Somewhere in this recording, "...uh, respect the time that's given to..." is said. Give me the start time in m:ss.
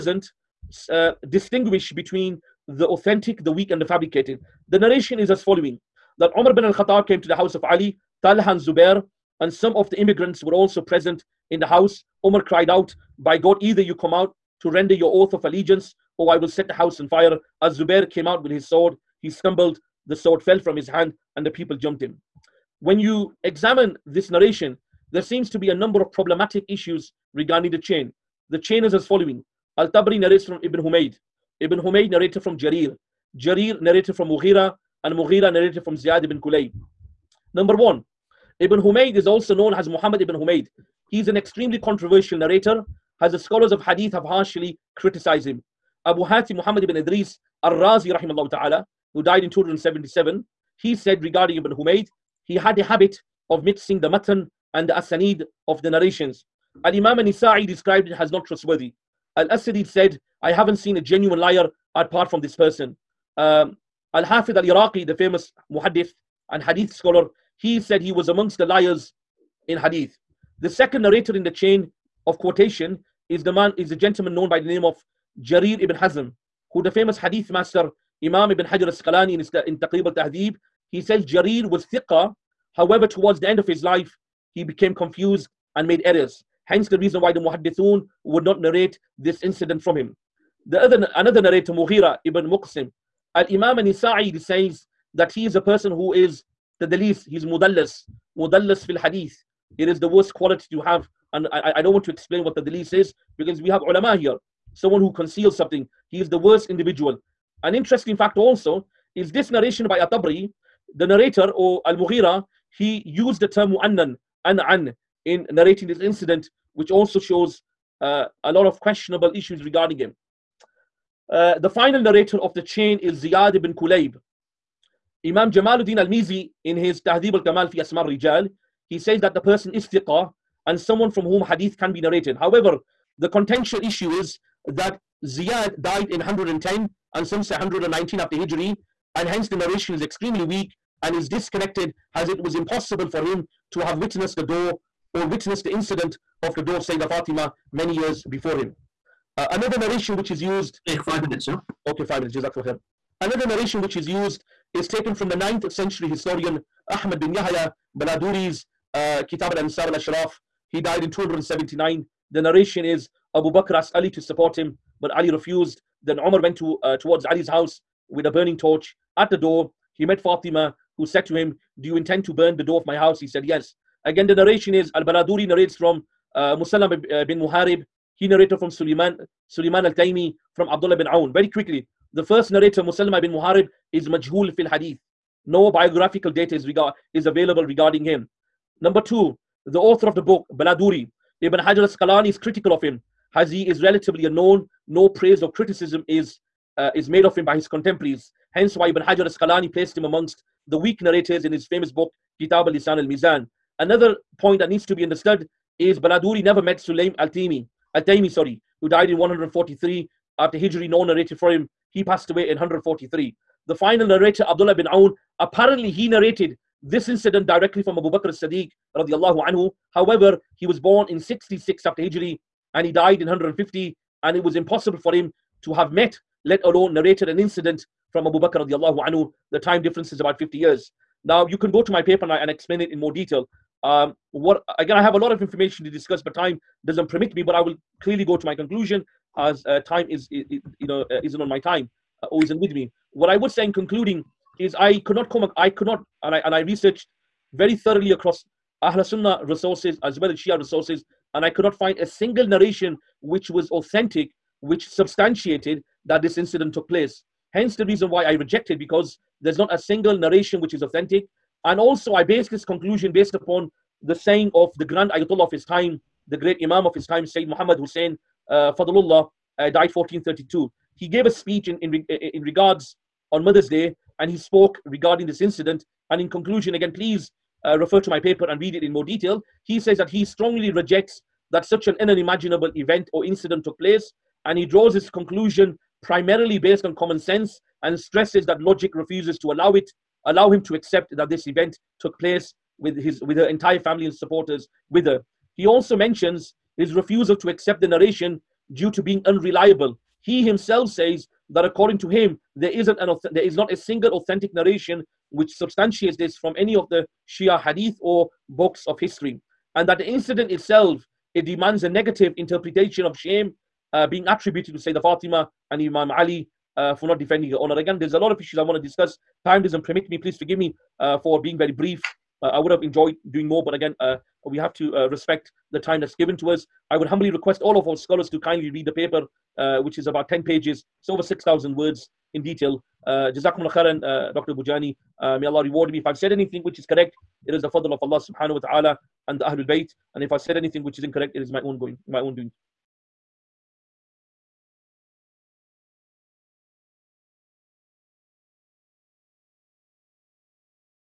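5:24.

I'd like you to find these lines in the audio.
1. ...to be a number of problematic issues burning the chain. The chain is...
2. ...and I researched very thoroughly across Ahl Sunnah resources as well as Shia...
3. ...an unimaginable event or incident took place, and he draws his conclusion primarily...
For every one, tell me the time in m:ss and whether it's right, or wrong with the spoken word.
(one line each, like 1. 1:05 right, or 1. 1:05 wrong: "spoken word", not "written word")
1. 0:25 wrong: "regarding", not "burning"
2. 4:06 right
3. 4:41 right.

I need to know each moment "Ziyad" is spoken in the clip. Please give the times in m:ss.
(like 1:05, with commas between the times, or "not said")
0:35, 2:03, 2:15.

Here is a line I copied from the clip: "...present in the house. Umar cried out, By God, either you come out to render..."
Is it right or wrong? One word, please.
right.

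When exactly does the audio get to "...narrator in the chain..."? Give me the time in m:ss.
1:11.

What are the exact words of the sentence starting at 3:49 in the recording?
The time difference is about 50 years.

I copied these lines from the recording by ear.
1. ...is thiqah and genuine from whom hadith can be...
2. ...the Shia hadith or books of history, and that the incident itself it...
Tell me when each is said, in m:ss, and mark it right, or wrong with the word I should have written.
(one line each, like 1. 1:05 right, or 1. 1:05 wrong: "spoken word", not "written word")
1. 2:09 wrong: "someone", not "genuine"
2. 5:06 right.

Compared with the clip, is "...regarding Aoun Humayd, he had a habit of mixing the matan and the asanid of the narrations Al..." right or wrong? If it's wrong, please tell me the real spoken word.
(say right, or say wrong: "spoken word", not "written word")
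wrong: "Ibn", not "Aoun".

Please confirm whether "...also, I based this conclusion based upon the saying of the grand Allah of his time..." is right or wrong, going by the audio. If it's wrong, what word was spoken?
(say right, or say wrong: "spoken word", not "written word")
wrong: "Ayatollah", not "Allah".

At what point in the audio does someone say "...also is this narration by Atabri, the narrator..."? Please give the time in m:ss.
1:48.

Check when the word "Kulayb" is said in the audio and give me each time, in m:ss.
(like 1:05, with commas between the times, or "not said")
0:36, 2:03.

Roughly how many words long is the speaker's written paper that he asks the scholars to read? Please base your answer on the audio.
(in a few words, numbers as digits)
over 6,000.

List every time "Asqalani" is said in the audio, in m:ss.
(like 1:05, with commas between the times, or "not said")
1:18, 3:11, 3:19.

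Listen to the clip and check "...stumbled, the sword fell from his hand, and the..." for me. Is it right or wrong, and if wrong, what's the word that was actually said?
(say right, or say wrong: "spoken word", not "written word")
right.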